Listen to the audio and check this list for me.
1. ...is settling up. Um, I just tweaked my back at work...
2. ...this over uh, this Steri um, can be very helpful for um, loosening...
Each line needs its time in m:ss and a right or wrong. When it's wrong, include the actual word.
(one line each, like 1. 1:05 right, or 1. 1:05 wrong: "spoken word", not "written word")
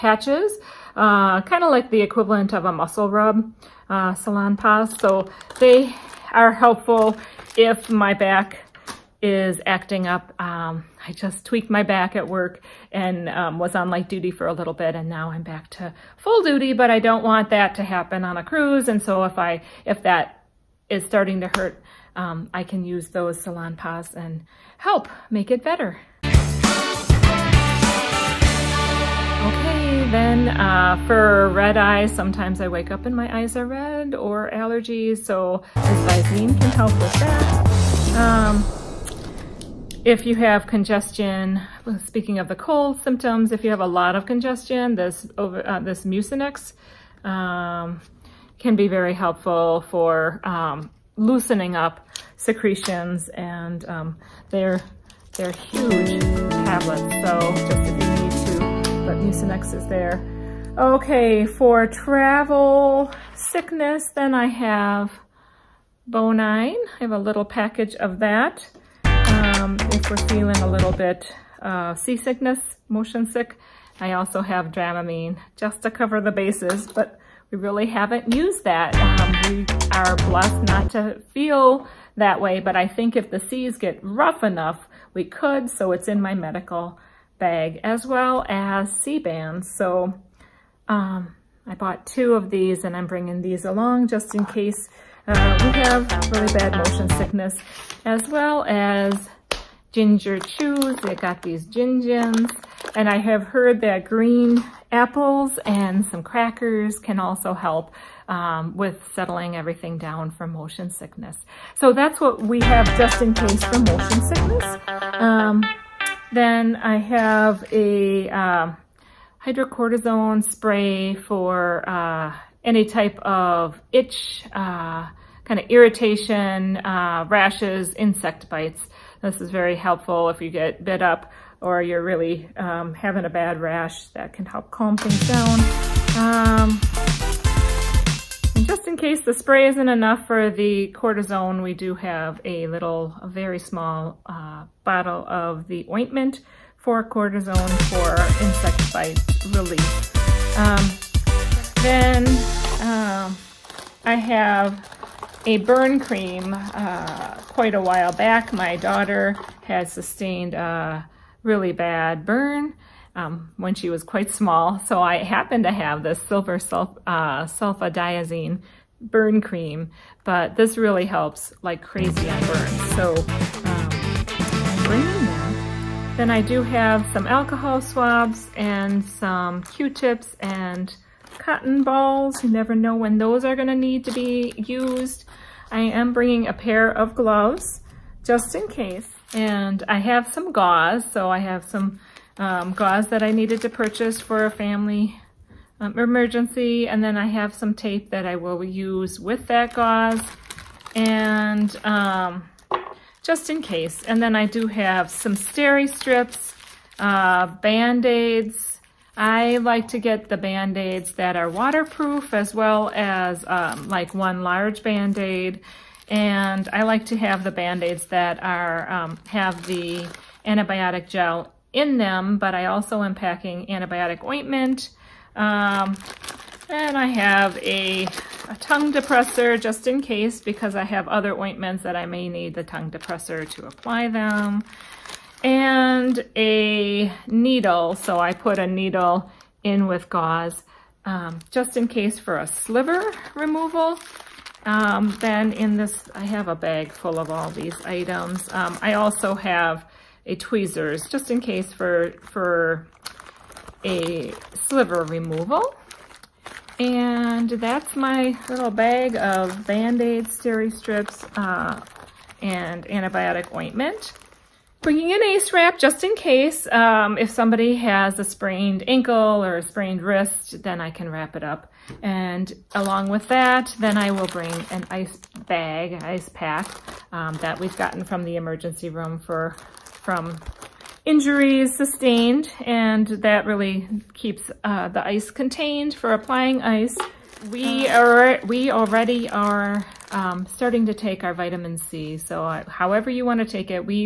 1. 0:09 wrong: "acting", not "settling"
2. 0:44 wrong: "Mucinex", not "Steri".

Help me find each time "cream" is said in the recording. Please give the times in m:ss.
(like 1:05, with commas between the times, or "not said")
2:35, 2:49.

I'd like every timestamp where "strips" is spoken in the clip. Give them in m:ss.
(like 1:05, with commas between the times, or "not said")
3:25, 4:20.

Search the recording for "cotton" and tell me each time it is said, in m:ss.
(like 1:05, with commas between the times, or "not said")
3:01.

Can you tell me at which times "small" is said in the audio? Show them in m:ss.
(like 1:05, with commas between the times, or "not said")
2:23, 2:44.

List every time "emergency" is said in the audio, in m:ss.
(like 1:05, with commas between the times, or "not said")
3:15, 4:38.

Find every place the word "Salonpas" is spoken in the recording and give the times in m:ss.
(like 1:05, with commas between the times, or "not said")
0:04, 0:23.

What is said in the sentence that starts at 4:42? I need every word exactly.
And that really keeps uh, the ice contained for applying ice.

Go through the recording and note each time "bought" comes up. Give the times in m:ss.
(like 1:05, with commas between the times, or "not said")
1:31.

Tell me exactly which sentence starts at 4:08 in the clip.
Um, I also have a tweezers just in case for, for a sliver removal.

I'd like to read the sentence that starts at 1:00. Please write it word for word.
Okay, for travel sickness, then I have Bonine.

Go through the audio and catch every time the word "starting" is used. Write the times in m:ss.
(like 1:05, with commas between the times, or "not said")
0:21, 4:50.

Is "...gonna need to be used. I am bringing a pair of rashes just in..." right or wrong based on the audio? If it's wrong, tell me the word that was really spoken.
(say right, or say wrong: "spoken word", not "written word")
wrong: "gloves", not "rashes".